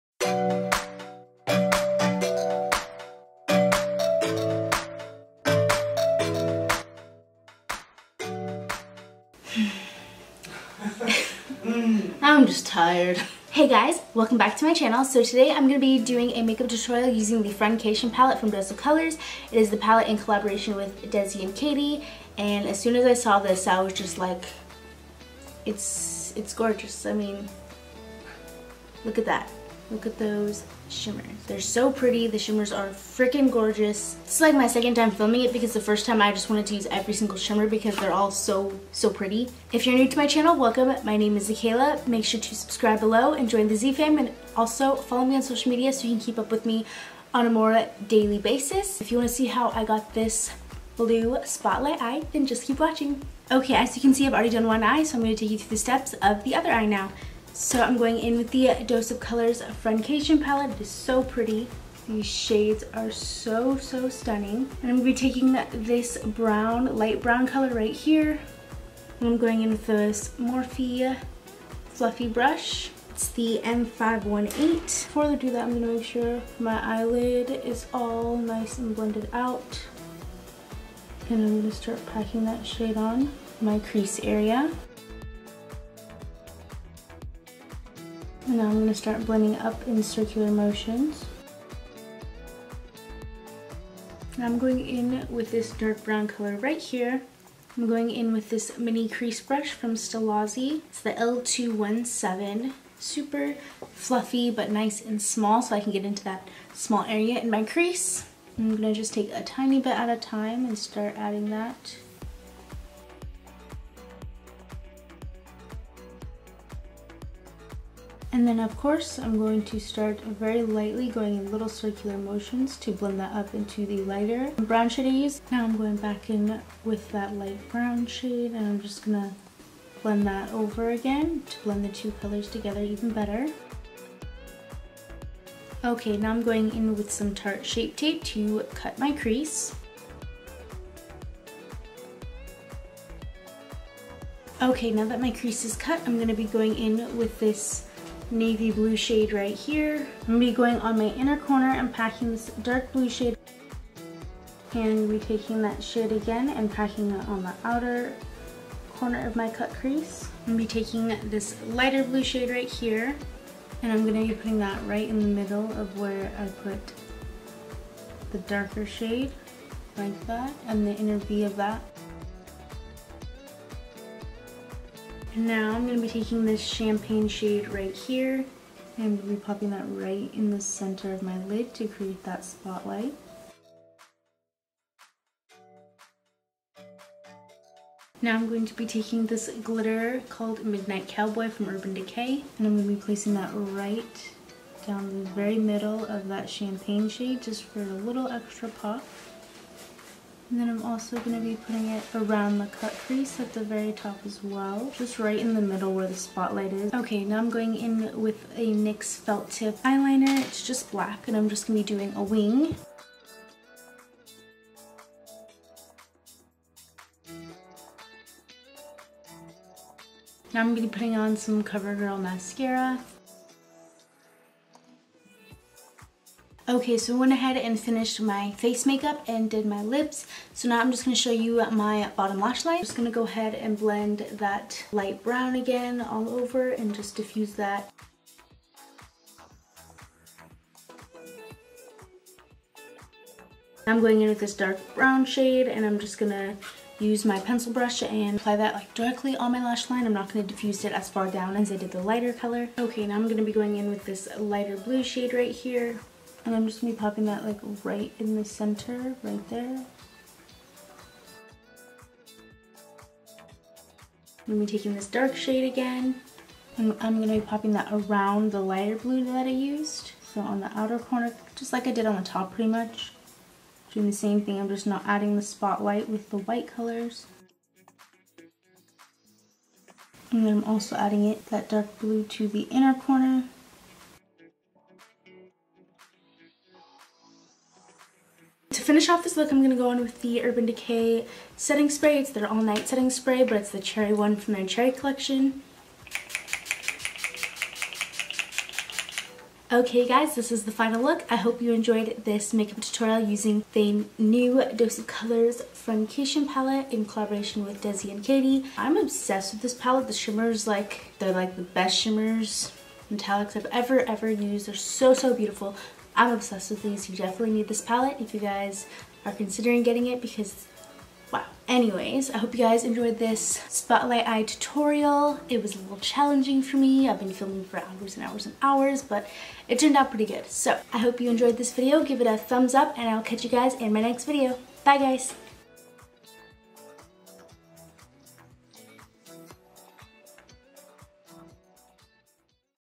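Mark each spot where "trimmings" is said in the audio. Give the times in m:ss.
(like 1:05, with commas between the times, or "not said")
not said.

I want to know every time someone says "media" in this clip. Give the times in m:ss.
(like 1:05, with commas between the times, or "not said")
0:45.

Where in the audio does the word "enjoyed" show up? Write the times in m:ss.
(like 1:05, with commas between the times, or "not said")
5:01, 5:22, 5:31.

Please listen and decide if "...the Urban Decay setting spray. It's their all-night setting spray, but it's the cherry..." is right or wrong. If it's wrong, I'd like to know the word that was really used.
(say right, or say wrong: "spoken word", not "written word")
right.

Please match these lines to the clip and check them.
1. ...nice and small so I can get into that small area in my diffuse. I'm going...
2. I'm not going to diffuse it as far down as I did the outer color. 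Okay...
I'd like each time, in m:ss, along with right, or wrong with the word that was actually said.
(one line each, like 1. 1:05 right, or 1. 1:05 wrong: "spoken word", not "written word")
1. 1:44 wrong: "crease", not "diffuse"
2. 4:10 wrong: "lighter", not "outer".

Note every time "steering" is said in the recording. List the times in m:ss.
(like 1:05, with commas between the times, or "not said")
not said.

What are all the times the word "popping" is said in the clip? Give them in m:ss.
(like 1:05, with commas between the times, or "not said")
2:59, 4:16, 4:27.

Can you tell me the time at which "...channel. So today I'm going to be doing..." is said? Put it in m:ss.
0:14.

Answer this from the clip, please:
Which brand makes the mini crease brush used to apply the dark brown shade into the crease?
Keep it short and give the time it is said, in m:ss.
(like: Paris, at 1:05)
Stilazzi, at 1:39.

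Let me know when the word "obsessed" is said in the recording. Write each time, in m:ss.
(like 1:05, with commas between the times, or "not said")
5:08, 5:16.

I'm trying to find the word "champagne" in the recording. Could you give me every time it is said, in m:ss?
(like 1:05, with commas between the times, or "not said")
2:56, 3:16.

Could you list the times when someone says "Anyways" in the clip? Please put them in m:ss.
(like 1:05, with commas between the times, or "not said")
5:21.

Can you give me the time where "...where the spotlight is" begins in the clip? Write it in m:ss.
3:25.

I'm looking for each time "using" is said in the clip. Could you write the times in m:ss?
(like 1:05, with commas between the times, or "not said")
0:17, 5:03.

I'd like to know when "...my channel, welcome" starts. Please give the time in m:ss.
0:40.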